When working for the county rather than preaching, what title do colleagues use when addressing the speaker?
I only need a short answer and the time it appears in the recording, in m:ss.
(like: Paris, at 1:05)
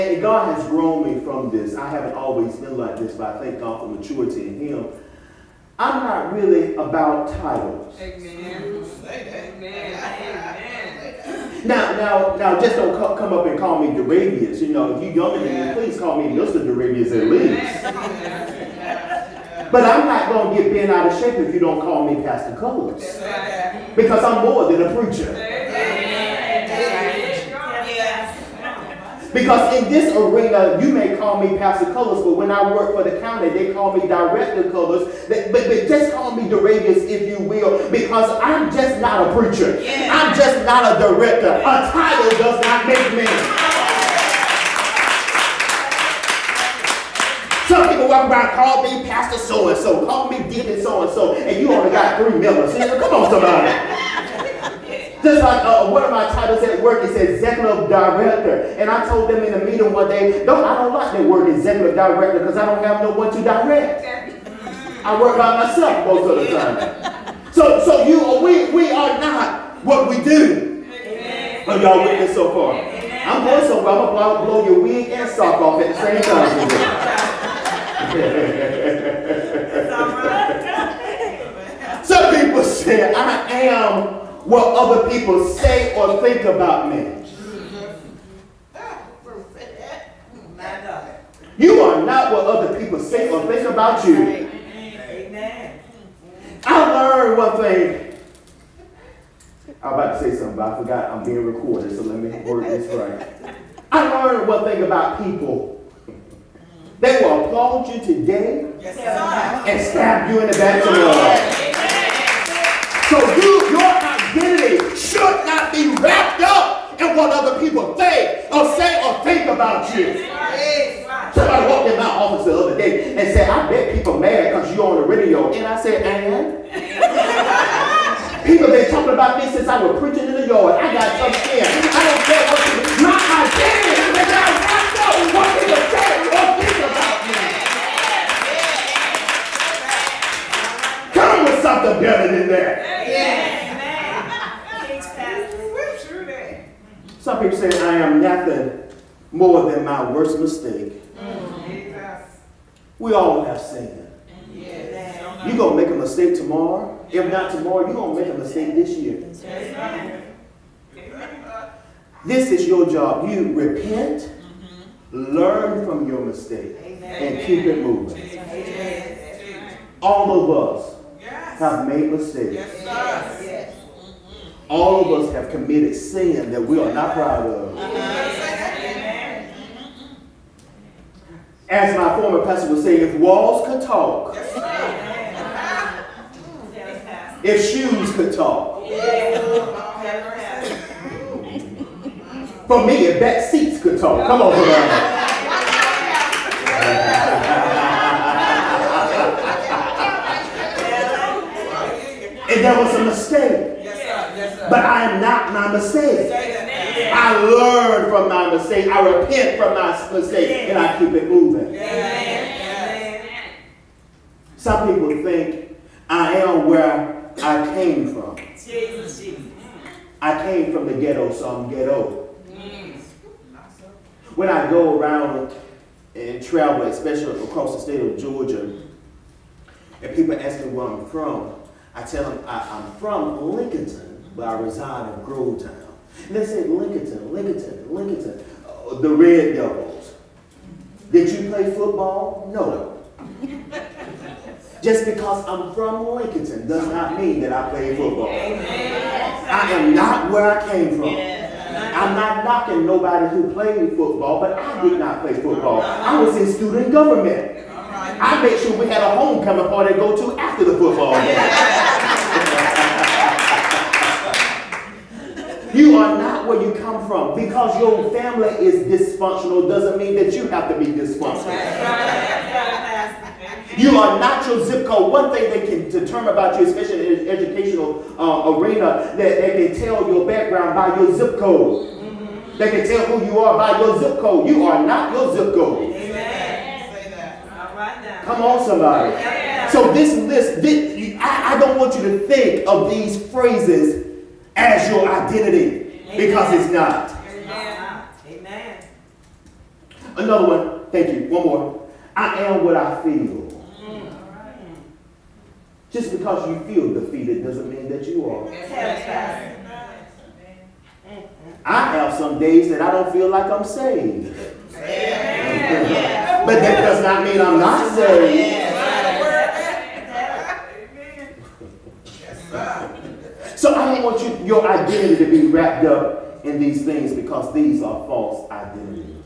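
Director Cullars, at 0:34.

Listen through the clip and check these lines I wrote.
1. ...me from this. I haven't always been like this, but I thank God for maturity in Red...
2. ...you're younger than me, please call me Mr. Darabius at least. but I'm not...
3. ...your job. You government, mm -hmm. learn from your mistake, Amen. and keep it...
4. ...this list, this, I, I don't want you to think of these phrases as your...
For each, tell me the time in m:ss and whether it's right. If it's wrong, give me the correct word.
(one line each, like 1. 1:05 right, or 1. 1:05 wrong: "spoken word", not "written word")
1. 0:01 wrong: "Him", not "Red"
2. 0:15 right
3. 2:42 wrong: "repent", not "government"
4. 4:49 right.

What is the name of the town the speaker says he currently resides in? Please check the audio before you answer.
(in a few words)
Grovetown.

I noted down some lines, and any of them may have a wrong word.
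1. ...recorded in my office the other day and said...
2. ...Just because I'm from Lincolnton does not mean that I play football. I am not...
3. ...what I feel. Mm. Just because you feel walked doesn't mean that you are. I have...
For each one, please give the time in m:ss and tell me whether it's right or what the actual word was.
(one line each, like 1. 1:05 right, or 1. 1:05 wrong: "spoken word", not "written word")
1. 2:01 wrong: "walked", not "recorded"
2. 4:04 right
3. 5:02 wrong: "defeated", not "walked".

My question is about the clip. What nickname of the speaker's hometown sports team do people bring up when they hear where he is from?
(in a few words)
the Red Devils.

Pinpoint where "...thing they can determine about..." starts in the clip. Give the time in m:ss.
4:35.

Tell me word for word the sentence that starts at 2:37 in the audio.
If not tomorrow, you're going to make a mistake this year.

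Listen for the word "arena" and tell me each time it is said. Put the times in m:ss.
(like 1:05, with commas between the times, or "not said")
0:30, 4:38.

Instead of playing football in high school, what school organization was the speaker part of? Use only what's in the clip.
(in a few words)
student government.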